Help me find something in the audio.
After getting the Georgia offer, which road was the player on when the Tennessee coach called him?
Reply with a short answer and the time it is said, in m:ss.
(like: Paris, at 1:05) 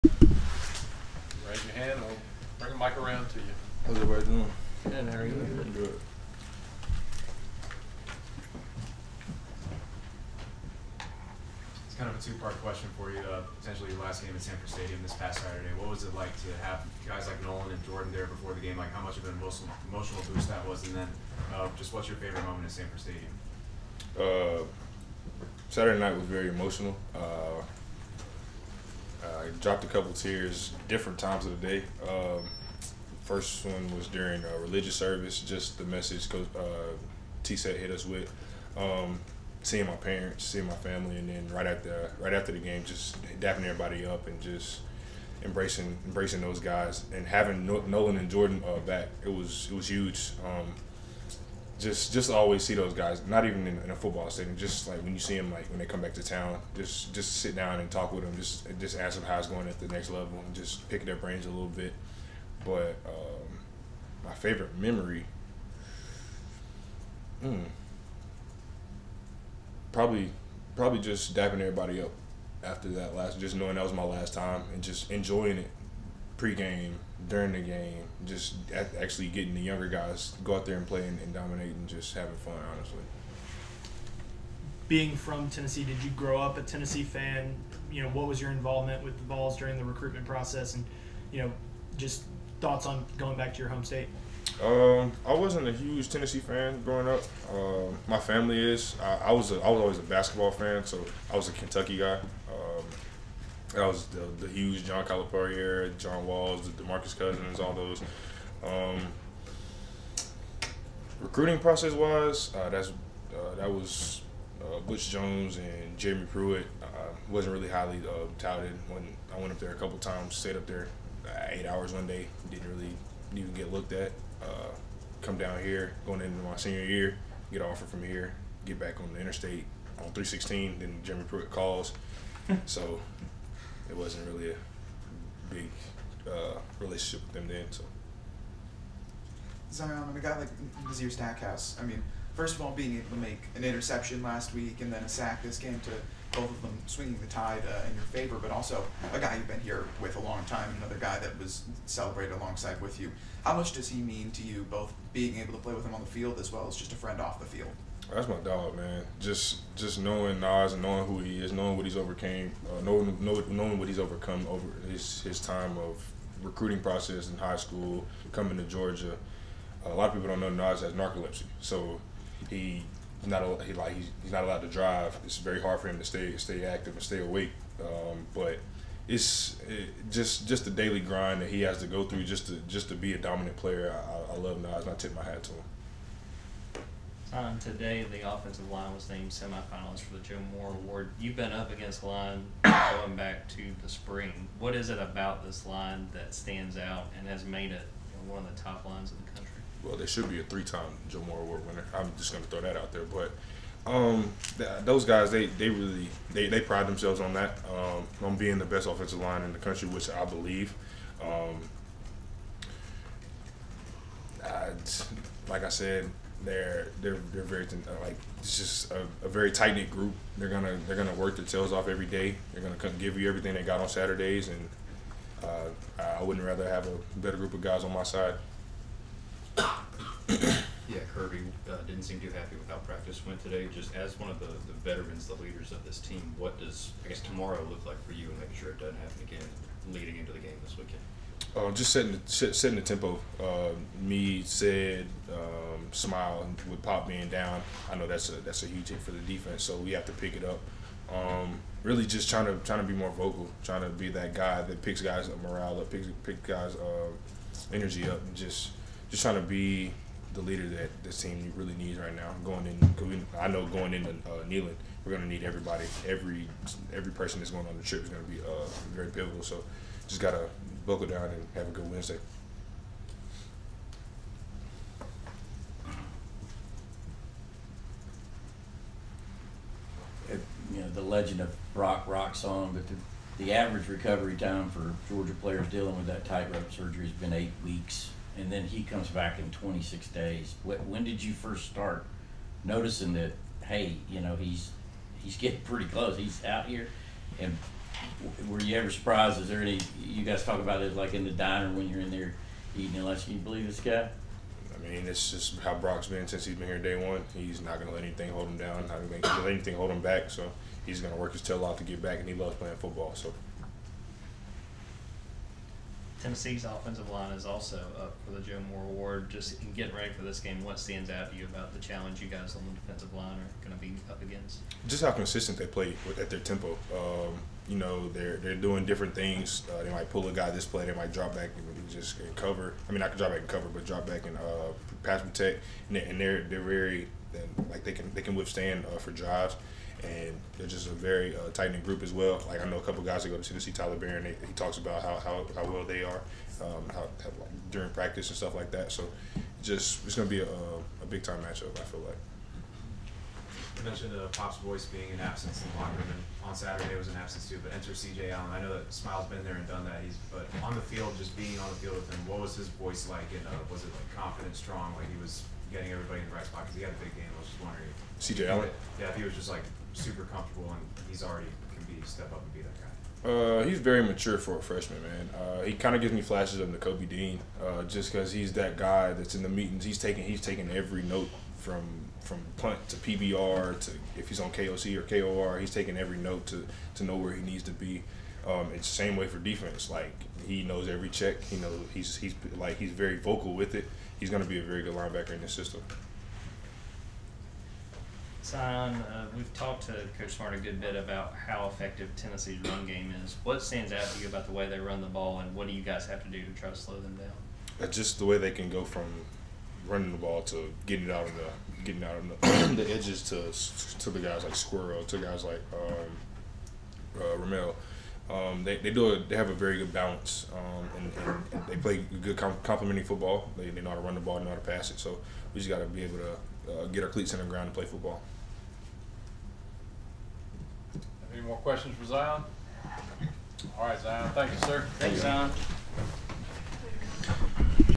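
316, at 2:10.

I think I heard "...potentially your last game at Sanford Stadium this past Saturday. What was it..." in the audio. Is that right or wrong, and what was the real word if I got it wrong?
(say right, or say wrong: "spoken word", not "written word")
right.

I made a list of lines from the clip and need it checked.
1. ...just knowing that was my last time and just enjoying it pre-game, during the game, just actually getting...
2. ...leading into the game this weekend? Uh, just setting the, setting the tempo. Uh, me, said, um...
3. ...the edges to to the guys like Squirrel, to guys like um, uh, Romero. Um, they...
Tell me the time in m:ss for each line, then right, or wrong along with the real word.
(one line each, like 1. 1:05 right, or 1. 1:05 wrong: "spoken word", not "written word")
1. 1:13 right
2. 3:59 right
3. 6:52 right.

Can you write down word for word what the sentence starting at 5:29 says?
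Uh, they might pull a guy this play, they might drop back and just and cover.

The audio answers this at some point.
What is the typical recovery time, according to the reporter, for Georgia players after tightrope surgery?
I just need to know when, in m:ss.
4:47.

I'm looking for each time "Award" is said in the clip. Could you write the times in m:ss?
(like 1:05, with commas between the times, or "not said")
3:10, 3:21, 5:18.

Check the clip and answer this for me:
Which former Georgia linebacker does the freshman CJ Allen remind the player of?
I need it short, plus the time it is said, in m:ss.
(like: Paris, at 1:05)
Nakobe Dean, at 6:16.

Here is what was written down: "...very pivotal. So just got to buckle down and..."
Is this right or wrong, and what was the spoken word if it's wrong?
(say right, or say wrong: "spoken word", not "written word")
right.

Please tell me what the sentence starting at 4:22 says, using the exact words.
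Going in, I know going into uh, Neyland, we're going to need everybody.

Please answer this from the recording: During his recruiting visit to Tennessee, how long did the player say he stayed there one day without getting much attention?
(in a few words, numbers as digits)
8 hours.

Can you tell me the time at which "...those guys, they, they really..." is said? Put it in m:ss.
3:24.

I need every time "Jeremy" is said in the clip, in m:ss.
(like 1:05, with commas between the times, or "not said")
1:55, 2:11.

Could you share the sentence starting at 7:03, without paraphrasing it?
They, they know how to run the ball, they know how to pass it.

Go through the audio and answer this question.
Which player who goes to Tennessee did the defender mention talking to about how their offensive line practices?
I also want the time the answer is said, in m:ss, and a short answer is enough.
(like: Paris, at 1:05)
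Tyler Baron, at 5:43.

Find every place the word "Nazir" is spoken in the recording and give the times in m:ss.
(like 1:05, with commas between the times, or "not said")
2:20.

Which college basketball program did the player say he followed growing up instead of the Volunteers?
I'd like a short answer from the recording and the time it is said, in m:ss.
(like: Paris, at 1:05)
Kentucky, at 1:41.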